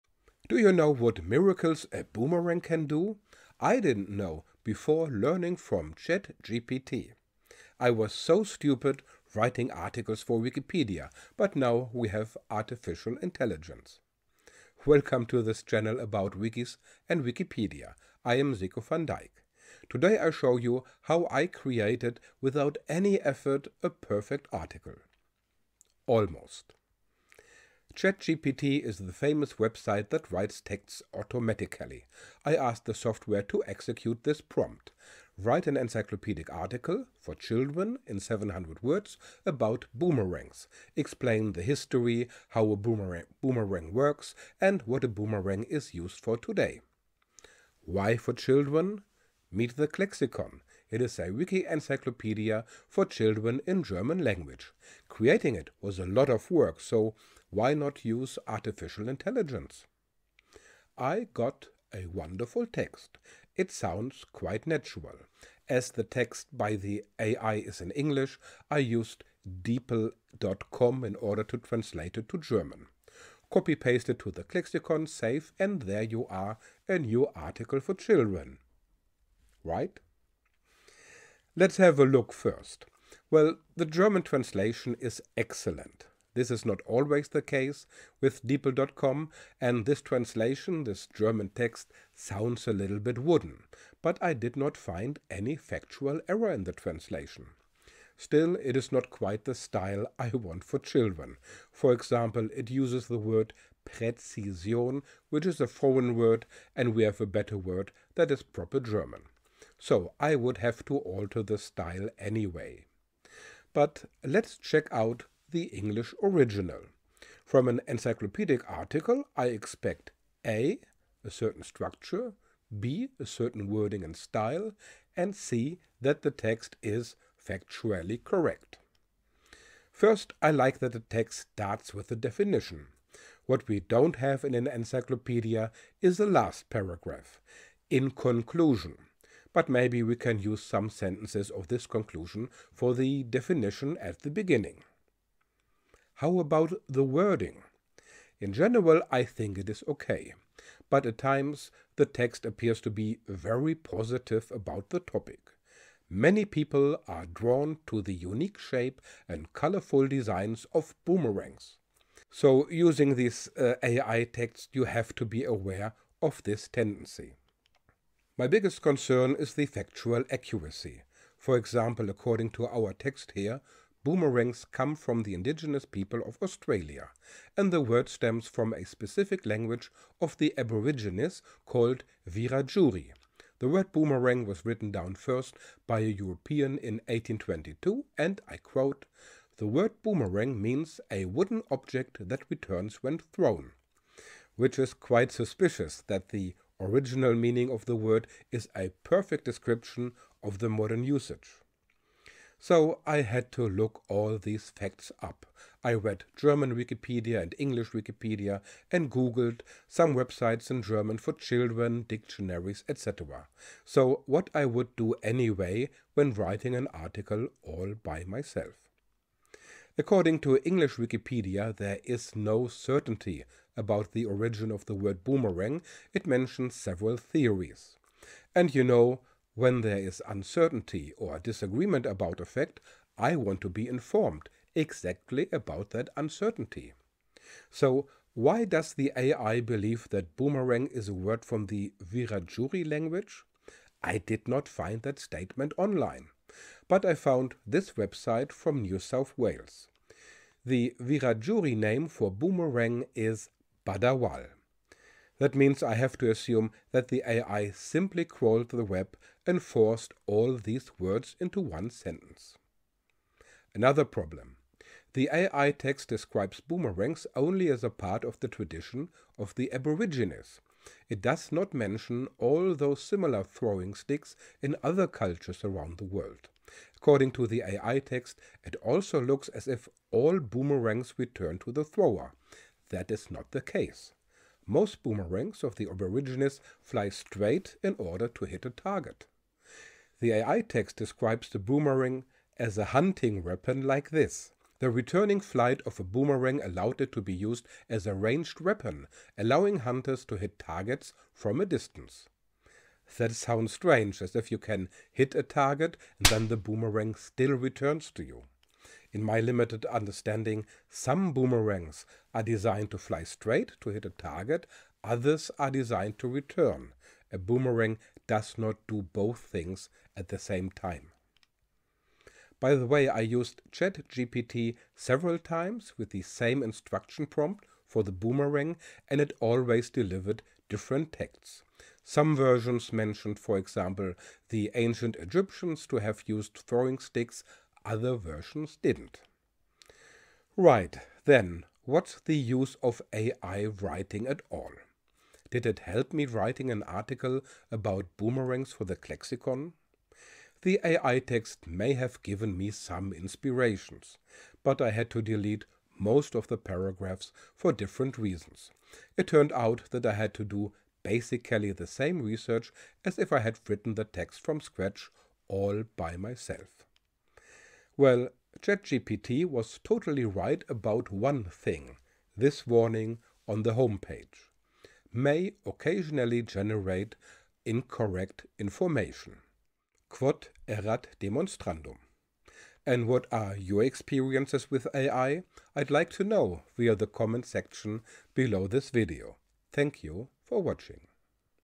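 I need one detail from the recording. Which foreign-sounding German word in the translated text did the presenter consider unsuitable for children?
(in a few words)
Präzision.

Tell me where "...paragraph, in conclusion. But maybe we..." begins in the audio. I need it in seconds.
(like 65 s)
136 s.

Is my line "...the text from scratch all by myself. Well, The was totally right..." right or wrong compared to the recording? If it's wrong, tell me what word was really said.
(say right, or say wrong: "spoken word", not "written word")
wrong: "ChatGPT", not "The".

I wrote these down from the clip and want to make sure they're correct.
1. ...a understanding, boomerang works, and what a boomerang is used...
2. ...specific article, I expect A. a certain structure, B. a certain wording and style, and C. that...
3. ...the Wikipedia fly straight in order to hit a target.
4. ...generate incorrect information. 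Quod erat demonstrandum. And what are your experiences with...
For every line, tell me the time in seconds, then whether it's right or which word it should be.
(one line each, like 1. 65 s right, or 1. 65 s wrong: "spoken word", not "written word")
1. 42 s wrong: "boomerang", not "understanding"
2. 117 s wrong: "encyclopedic", not "specific"
3. 285 s wrong: "Aborigines", not "Wikipedia"
4. 376 s right.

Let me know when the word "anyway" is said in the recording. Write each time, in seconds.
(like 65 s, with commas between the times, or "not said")
112 s, 215 s.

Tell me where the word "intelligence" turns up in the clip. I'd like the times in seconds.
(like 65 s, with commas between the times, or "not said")
13 s, 59 s.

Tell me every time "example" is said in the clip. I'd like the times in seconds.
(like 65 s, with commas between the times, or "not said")
101 s, 171 s, 333 s.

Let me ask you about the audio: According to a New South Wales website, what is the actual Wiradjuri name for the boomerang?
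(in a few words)
Badawal.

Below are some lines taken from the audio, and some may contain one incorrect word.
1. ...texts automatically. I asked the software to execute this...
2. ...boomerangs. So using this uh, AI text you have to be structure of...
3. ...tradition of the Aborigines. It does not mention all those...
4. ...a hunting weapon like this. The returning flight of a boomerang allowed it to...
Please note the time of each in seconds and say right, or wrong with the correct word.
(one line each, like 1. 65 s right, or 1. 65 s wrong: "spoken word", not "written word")
1. 30 s right
2. 161 s wrong: "aware", not "structure"
3. 268 s right
4. 292 s right.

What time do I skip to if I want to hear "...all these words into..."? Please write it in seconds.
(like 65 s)
260 s.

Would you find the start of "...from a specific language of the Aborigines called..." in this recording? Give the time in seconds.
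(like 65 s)
178 s.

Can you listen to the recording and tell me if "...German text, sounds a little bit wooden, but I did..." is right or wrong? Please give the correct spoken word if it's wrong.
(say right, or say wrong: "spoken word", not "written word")
right.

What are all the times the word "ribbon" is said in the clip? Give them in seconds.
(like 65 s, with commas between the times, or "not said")
not said.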